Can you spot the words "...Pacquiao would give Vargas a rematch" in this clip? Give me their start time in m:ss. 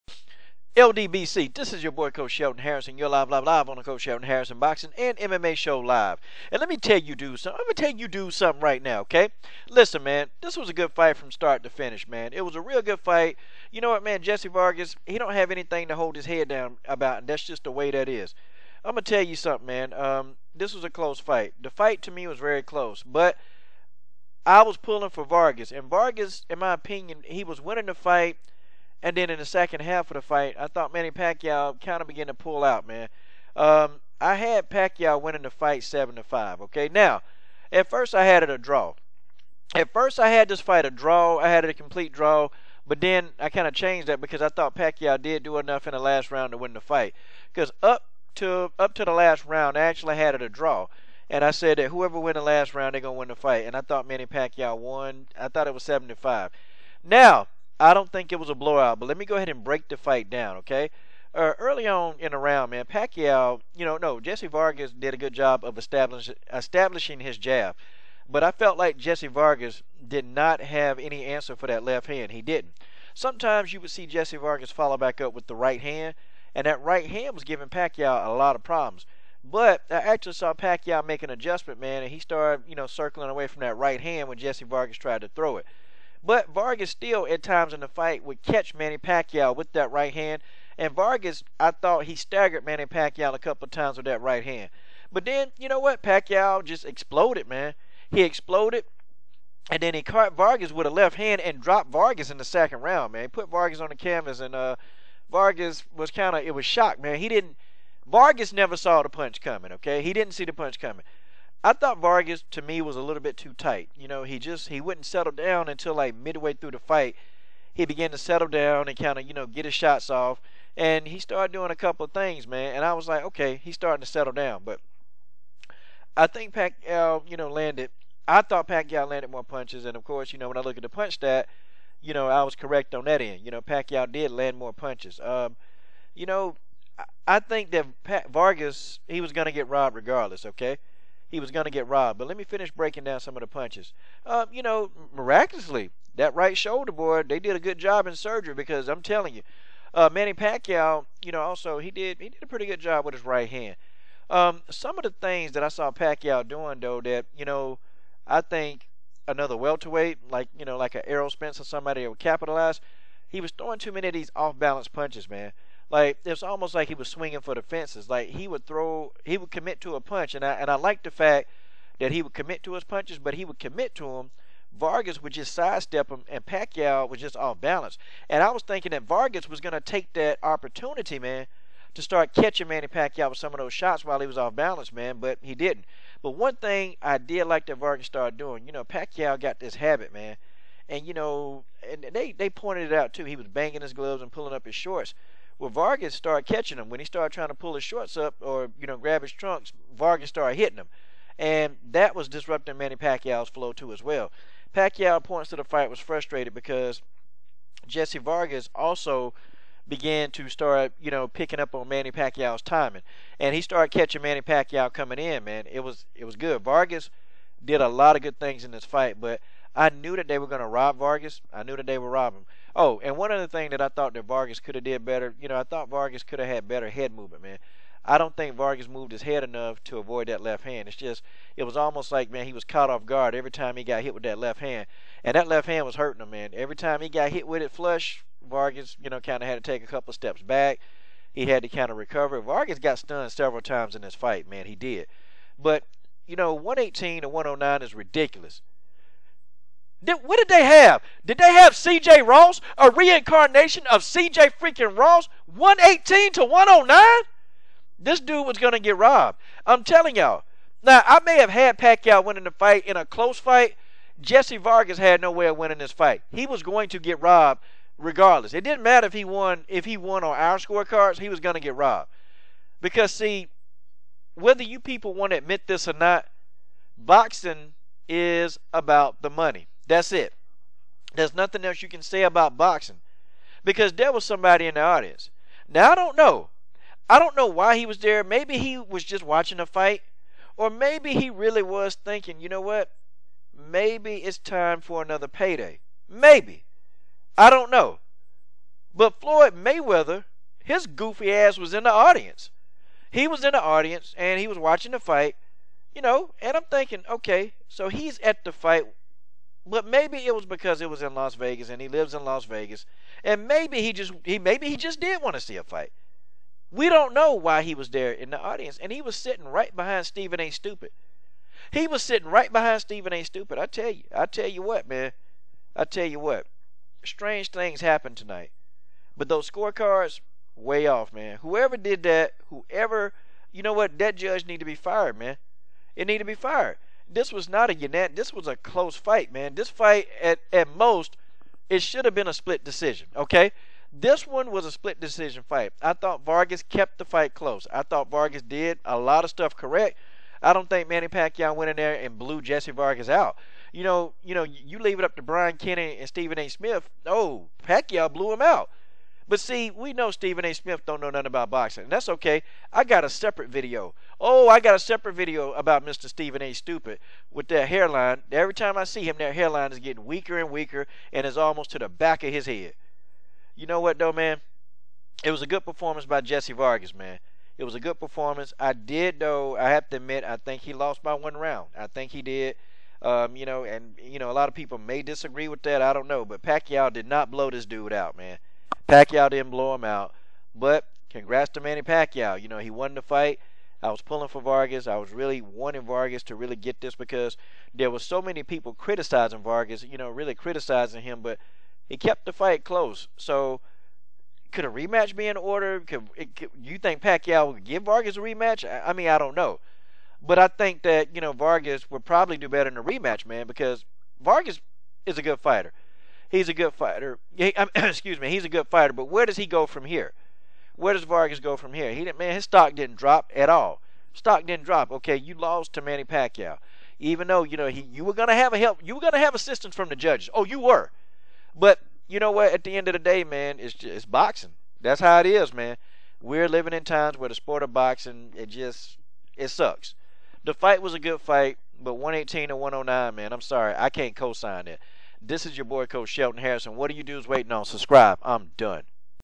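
6:47.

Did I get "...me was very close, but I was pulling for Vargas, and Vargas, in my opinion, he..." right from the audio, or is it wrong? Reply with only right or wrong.
right.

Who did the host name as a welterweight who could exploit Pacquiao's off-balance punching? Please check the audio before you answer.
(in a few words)
Errol Spence.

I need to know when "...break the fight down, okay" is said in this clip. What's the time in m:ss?
0:59.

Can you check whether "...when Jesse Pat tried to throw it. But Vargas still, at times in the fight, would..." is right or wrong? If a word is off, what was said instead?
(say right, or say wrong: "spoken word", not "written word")
wrong: "Vargas", not "Pat".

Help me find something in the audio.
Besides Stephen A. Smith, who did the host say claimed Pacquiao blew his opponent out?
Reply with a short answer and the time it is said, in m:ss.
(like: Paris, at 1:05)
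Brian Kenny, at 5:55.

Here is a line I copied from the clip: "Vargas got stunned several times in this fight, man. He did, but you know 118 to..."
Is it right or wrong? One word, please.
right.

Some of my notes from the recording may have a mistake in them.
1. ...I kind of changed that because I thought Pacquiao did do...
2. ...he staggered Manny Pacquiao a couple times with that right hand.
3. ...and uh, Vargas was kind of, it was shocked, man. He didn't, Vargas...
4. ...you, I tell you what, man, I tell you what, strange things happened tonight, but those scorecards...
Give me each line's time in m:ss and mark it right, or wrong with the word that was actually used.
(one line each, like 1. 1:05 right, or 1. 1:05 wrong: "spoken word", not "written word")
1. 0:43 right
2. 1:32 right
3. 1:44 right
4. 5:23 right.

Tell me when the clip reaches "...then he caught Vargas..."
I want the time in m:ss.
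1:39.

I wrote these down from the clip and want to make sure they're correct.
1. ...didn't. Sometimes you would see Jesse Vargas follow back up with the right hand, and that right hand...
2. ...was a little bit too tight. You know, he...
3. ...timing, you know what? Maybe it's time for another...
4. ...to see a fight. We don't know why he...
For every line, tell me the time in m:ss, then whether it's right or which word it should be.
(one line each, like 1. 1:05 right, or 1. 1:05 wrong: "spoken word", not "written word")
1. 1:12 right
2. 1:52 right
3. 4:51 wrong: "thinking", not "timing"
4. 5:15 right.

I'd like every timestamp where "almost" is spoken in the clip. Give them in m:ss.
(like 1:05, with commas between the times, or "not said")
2:46, 3:51, 6:11.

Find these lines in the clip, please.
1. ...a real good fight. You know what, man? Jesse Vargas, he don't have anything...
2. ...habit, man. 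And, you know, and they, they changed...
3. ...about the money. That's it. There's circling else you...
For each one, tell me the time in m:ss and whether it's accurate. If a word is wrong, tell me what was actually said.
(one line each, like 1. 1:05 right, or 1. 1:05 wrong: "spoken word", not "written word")
1. 0:12 right
2. 3:09 wrong: "pointed", not "changed"
3. 4:38 wrong: "nothing", not "circling".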